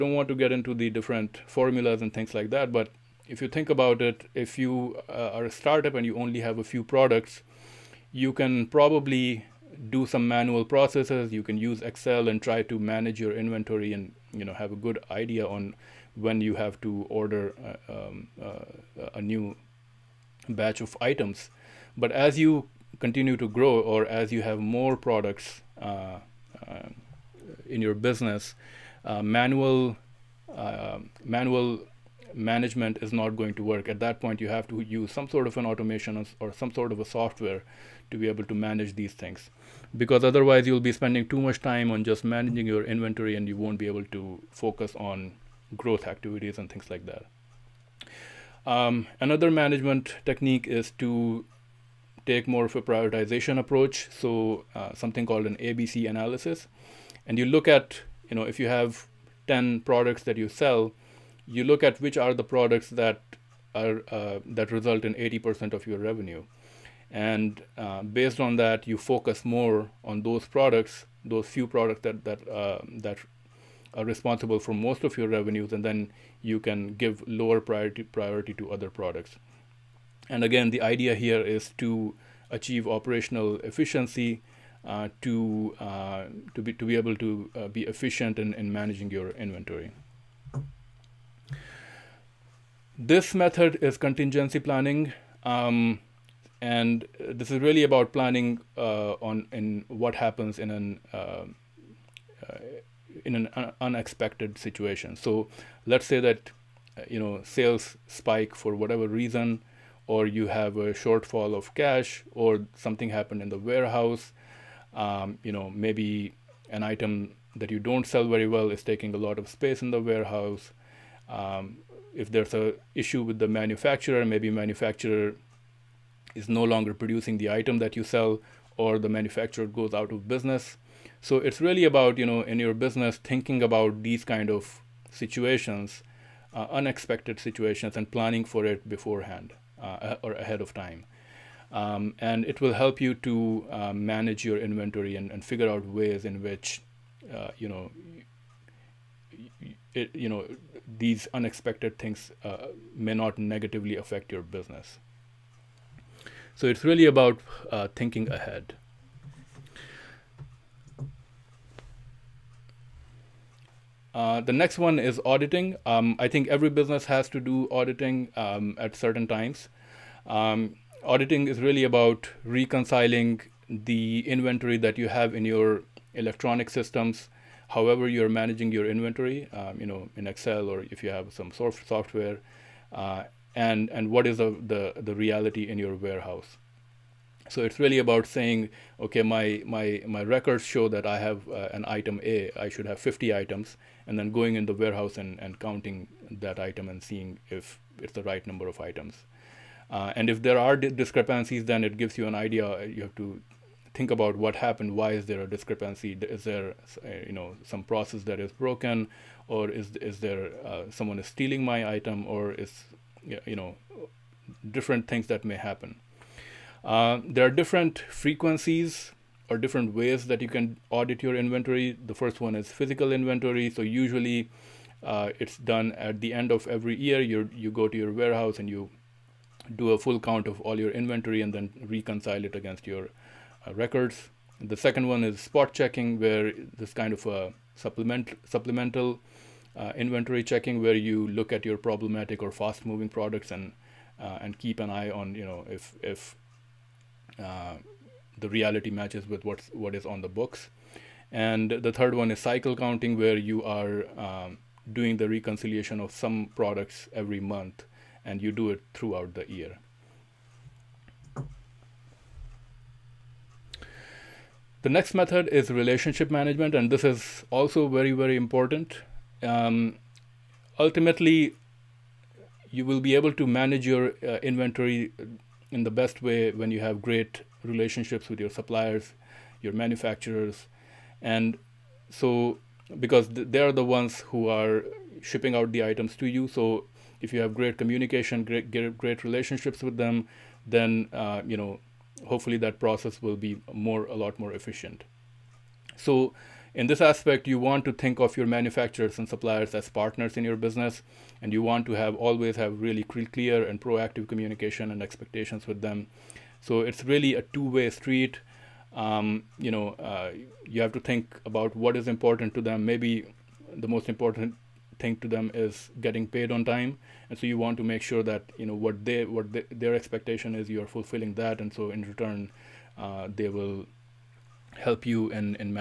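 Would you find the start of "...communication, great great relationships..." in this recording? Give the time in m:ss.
4:47.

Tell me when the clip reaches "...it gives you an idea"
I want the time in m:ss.
3:21.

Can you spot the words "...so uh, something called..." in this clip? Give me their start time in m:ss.
0:54.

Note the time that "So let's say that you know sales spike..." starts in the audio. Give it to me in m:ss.
1:45.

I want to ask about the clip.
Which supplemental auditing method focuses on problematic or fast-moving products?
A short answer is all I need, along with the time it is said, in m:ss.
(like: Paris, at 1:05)
spot checking, at 3:55.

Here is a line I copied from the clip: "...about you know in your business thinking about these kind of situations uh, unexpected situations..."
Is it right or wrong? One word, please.
right.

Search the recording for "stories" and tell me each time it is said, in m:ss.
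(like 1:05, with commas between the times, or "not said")
not said.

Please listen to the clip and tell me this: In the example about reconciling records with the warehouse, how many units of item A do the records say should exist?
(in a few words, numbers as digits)
50.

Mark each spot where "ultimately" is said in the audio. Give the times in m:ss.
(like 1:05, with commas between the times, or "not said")
4:30.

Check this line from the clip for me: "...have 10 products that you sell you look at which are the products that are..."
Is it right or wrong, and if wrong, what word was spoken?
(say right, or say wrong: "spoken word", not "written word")
right.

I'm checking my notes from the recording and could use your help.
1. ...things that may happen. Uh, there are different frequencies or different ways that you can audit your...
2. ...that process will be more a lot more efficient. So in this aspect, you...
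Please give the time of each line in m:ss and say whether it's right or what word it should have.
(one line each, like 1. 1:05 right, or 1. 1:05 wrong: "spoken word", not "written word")
1. 3:35 right
2. 4:52 right.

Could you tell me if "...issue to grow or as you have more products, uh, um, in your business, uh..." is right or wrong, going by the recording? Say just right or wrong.
wrong.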